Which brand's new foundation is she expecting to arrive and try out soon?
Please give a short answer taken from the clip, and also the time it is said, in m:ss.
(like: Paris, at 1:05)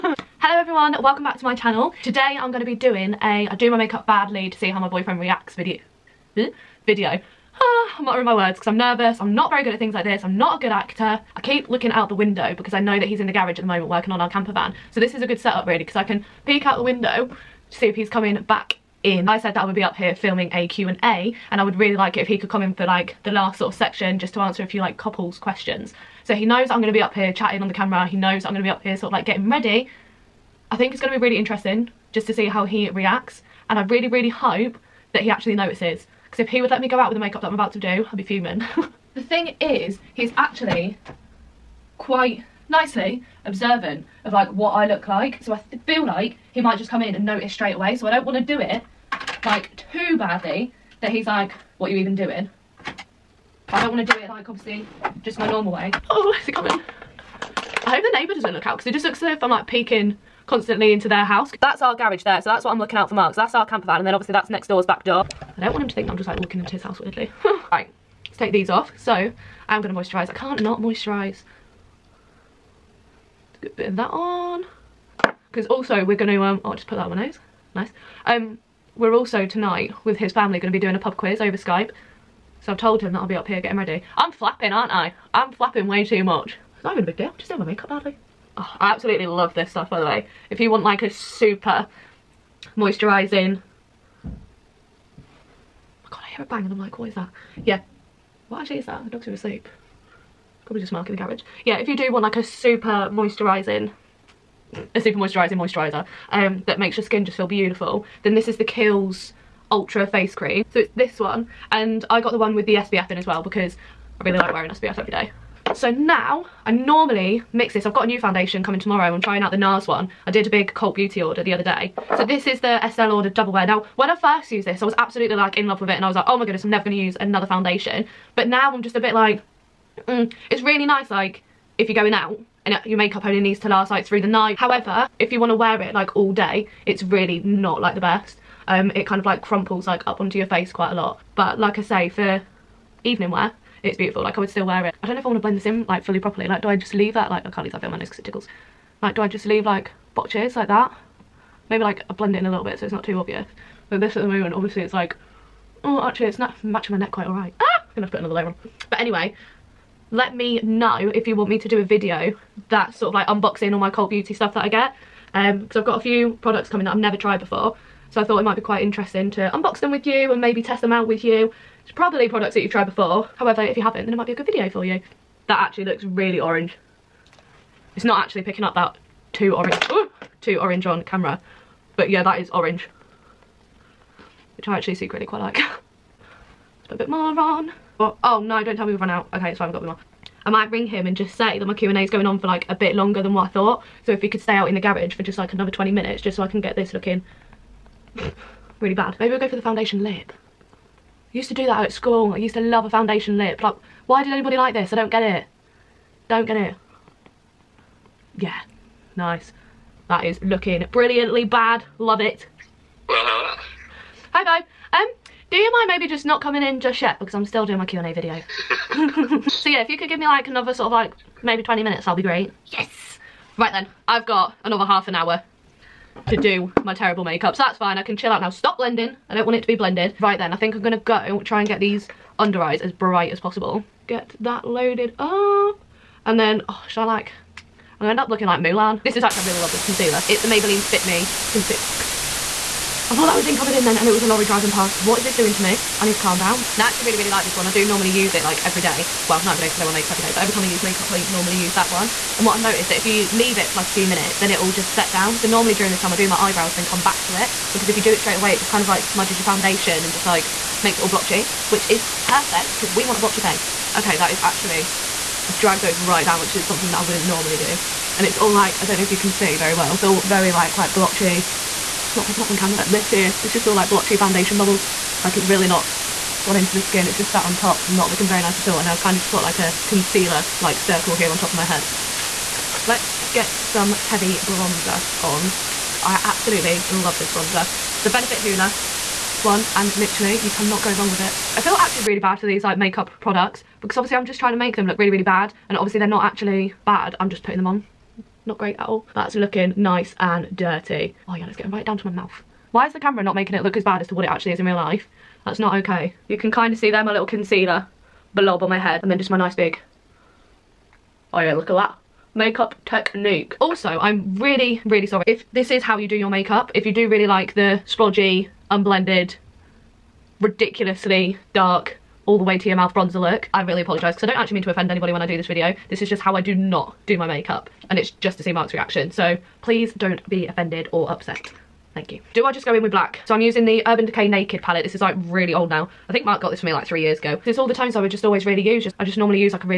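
NARS, at 1:59.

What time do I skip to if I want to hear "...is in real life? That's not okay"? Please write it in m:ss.
5:04.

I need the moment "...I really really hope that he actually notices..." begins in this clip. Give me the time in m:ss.
0:33.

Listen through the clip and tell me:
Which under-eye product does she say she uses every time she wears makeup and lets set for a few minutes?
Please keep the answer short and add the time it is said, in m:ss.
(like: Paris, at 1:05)
Maybelline Fit Me concealer, at 4:00.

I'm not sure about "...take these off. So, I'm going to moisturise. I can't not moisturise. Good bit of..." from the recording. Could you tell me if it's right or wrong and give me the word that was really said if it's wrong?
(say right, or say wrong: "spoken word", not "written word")
right.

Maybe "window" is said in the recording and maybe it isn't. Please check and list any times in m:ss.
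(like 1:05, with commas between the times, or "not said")
0:12, 0:16.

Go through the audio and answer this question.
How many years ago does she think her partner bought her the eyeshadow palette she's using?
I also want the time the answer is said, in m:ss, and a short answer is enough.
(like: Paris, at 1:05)
3, at 5:36.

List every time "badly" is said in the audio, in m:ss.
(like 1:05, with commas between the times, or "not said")
0:04, 0:50, 1:27.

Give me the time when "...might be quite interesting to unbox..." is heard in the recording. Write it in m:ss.
2:48.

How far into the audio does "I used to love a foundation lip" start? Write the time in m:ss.
3:22.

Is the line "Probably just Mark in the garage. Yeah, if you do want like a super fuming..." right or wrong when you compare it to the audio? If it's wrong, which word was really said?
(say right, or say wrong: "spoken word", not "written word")
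wrong: "moisturising", not "fuming".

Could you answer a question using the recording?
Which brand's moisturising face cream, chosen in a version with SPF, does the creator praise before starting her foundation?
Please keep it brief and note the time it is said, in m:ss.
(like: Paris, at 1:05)
Kiehl's Ultra Face Cream, at 1:48.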